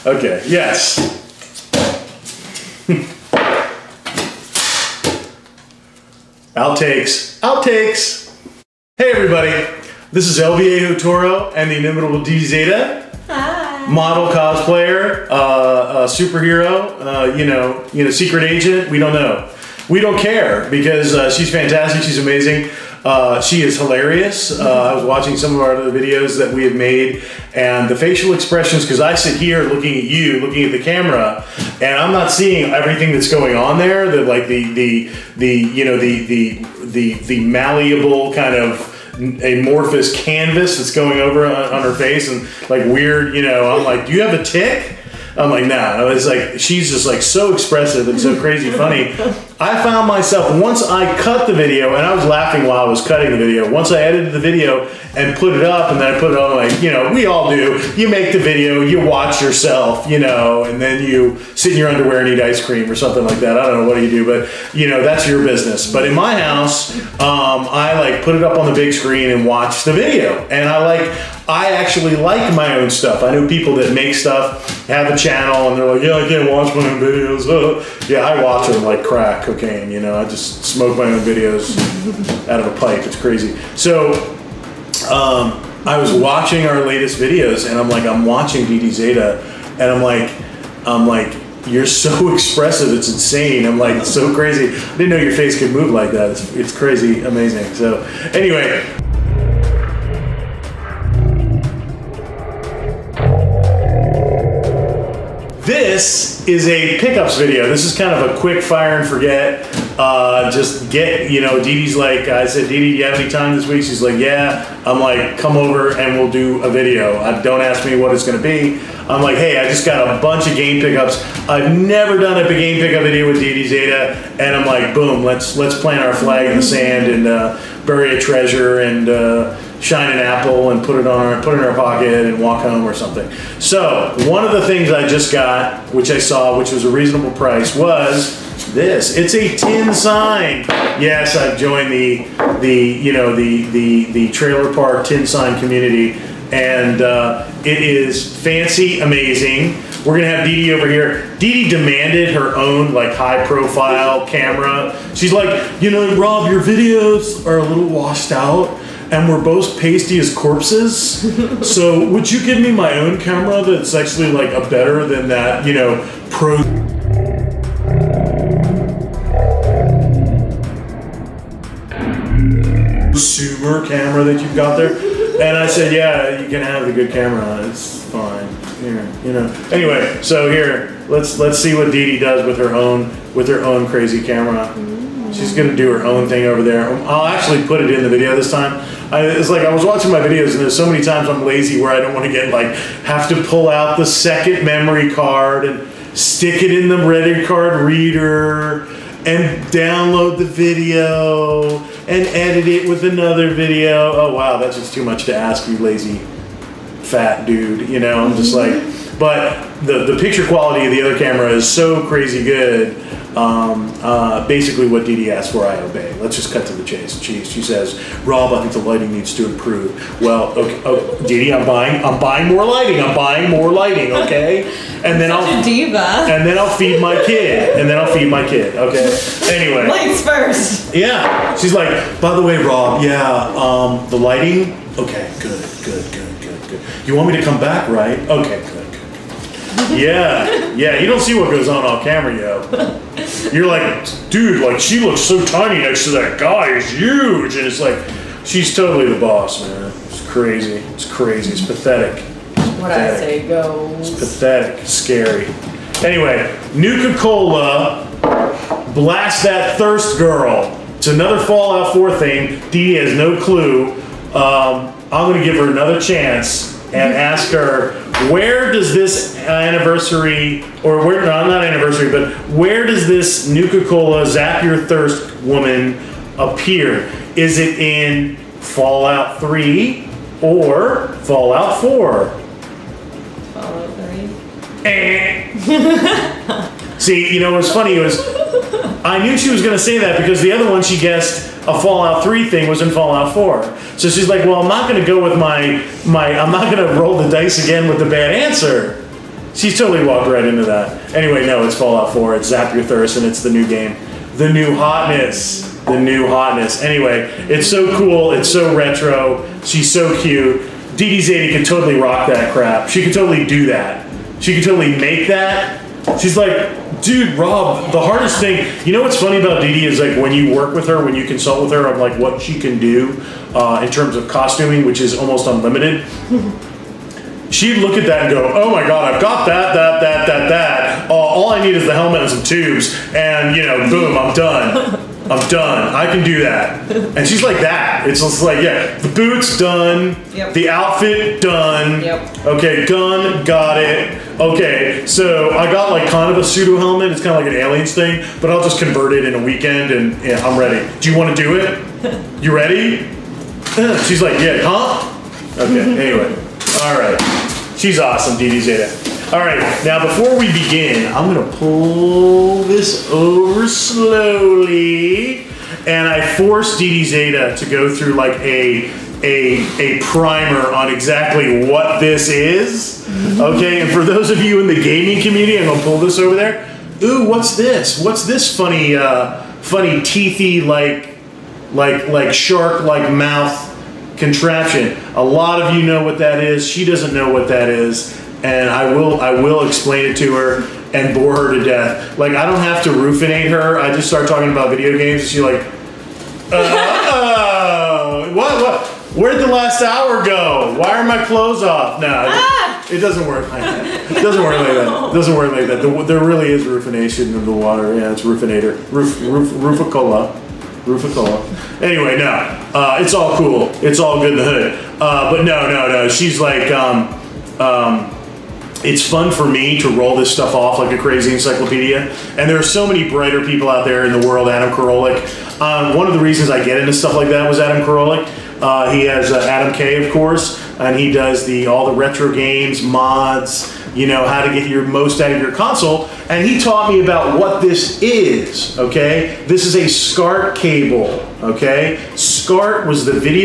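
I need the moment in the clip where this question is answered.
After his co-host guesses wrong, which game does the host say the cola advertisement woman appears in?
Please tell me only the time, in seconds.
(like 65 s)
301 s.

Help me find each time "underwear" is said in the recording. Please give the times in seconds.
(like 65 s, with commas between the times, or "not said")
61 s.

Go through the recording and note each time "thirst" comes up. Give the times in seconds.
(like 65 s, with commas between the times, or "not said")
259 s, 274 s, 302 s.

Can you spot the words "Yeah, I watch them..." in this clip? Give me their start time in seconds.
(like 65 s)
78 s.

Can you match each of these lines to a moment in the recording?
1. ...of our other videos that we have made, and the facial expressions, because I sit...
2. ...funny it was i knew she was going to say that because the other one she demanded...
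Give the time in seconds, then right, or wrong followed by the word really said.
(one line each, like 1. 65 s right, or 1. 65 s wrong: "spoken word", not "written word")
1. 25 s right
2. 287 s wrong: "guessed", not "demanded".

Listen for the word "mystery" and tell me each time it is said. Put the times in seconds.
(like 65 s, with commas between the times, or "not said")
not said.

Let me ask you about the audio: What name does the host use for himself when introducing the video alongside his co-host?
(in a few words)
El Viejo Toro.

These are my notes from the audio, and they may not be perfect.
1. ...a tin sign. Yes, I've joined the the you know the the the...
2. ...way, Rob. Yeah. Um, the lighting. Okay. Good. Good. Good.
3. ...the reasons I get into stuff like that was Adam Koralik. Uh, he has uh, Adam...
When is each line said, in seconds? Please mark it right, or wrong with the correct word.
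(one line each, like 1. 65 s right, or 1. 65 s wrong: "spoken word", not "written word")
1. 139 s right
2. 232 s right
3. 426 s right.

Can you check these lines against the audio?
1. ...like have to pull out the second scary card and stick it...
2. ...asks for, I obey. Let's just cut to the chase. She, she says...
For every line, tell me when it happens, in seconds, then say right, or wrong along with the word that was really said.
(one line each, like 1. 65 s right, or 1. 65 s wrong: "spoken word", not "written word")
1. 192 s wrong: "memory", not "scary"
2. 215 s right.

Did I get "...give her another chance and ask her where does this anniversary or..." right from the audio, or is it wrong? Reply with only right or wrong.
right.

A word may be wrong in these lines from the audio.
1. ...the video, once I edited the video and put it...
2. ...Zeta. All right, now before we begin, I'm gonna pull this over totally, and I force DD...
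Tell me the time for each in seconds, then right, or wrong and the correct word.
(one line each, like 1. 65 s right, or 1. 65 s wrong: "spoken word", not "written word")
1. 53 s right
2. 358 s wrong: "slowly", not "totally".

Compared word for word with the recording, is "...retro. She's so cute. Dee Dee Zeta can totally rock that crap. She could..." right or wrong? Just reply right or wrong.
right.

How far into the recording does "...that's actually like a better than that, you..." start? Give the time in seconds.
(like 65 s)
163 s.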